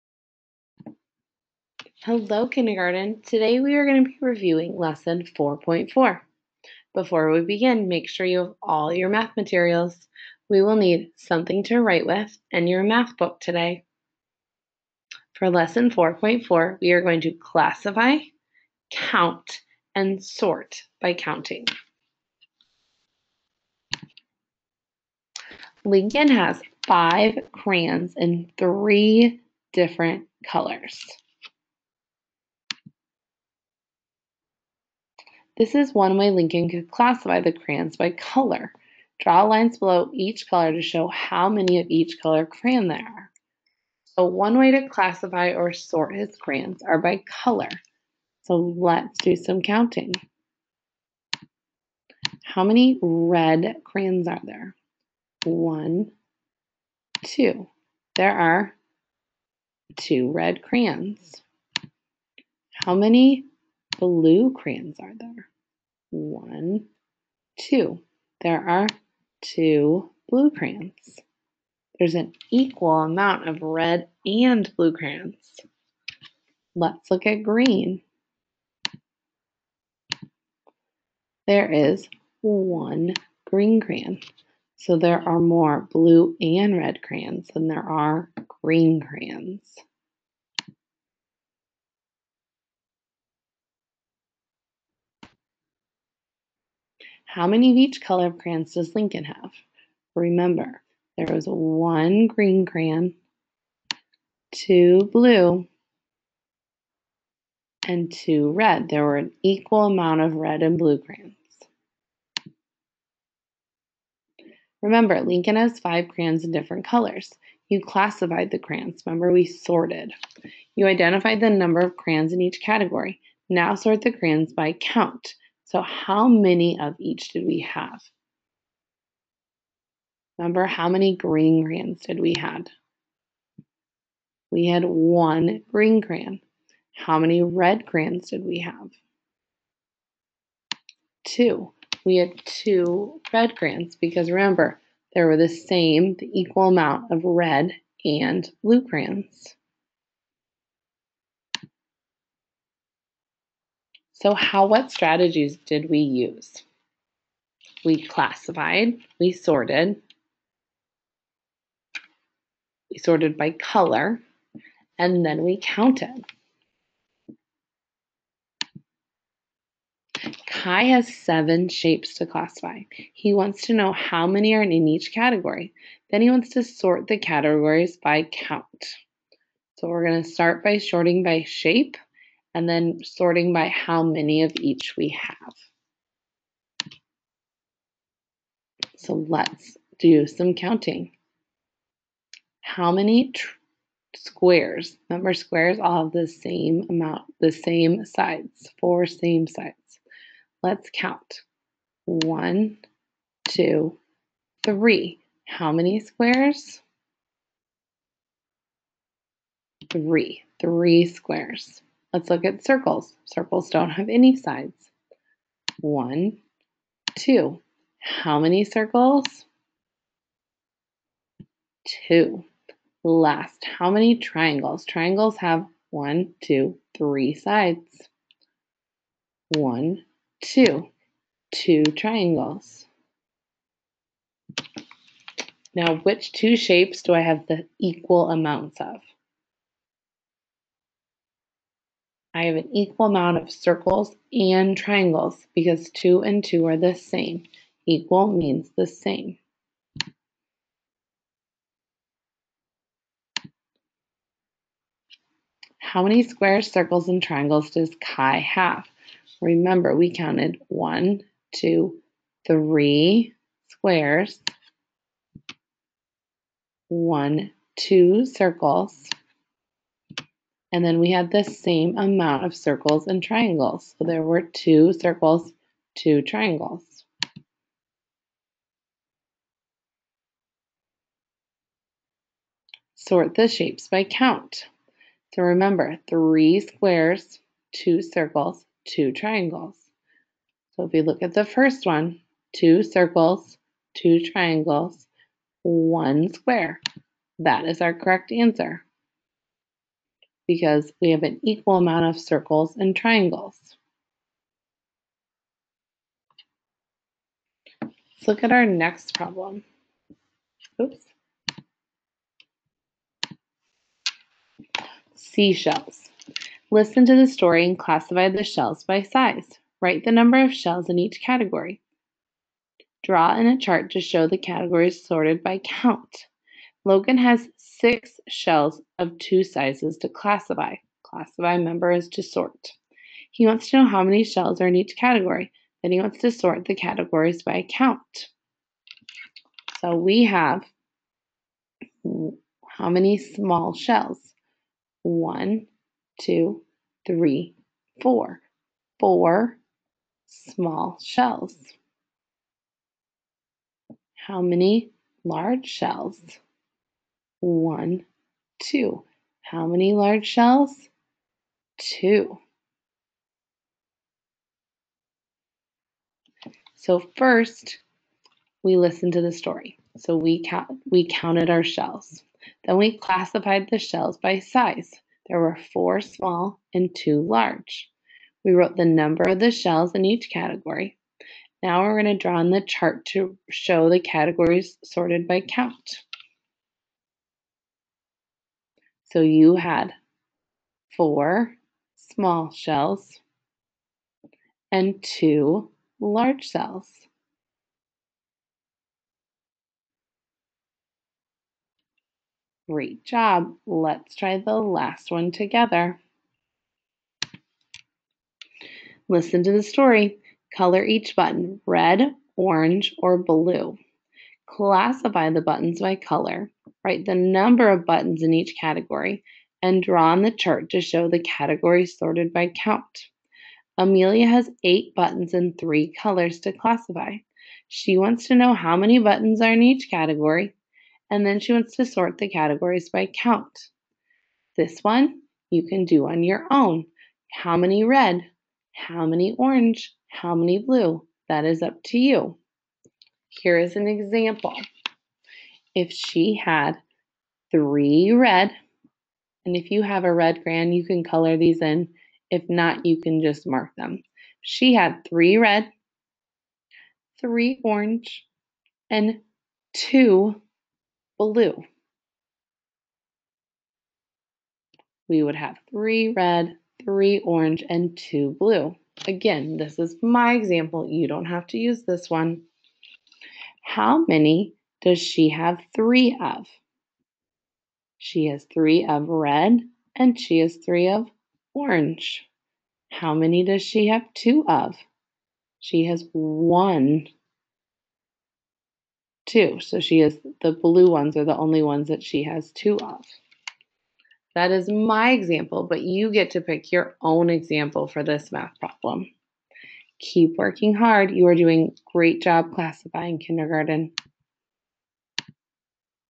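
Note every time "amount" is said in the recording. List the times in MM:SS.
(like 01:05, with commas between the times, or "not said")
01:13, 01:49, 02:26, 03:16, 03:58, 04:03, 04:31, 05:01.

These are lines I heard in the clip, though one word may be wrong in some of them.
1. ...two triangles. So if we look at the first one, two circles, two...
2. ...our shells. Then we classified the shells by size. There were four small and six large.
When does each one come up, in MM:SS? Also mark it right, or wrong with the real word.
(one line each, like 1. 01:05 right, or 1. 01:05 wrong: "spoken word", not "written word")
1. 04:48 right
2. 06:11 wrong: "two", not "six".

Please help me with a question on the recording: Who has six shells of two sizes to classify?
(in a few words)
Logan.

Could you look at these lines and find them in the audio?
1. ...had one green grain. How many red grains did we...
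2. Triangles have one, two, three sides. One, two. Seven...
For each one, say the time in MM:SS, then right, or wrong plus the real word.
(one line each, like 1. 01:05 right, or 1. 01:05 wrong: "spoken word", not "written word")
1. 02:14 right
2. 03:44 wrong: "Two", not "Seven".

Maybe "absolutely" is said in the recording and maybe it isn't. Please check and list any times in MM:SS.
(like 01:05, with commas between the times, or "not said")
not said.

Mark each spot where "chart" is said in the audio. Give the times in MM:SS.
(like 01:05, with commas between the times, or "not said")
05:23, 06:22, 07:00.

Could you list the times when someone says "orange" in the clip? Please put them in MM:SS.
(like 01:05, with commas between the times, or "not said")
06:52, 07:19, 07:37, 07:47, 08:01.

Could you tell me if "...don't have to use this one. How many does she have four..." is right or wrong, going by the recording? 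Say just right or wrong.
wrong.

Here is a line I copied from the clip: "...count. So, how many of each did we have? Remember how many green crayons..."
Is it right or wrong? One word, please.
wrong.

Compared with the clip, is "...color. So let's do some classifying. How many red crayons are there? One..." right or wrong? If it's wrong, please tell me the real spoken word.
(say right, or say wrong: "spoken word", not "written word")
wrong: "counting", not "classifying".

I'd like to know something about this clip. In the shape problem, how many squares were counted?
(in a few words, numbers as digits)
3.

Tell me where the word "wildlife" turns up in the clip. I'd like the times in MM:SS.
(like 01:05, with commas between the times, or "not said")
not said.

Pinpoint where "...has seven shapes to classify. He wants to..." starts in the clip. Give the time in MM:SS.
02:50.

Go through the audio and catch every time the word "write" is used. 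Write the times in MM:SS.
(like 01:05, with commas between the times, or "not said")
00:11, 05:19, 06:56.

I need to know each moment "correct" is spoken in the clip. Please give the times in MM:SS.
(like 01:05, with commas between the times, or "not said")
04:57.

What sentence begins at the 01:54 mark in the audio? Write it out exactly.
Remember, Lincoln has five crayons in different colors.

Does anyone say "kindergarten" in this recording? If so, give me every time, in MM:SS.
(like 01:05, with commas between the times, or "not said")
00:02, 08:23.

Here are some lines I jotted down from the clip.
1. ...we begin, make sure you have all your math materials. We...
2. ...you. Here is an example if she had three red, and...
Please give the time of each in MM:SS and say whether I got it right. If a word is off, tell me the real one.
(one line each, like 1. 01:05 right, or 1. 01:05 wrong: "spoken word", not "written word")
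1. 00:07 right
2. 07:21 right.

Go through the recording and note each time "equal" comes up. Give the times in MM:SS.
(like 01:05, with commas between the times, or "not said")
01:12, 01:49, 02:26, 03:57, 04:02, 04:07, 05:01.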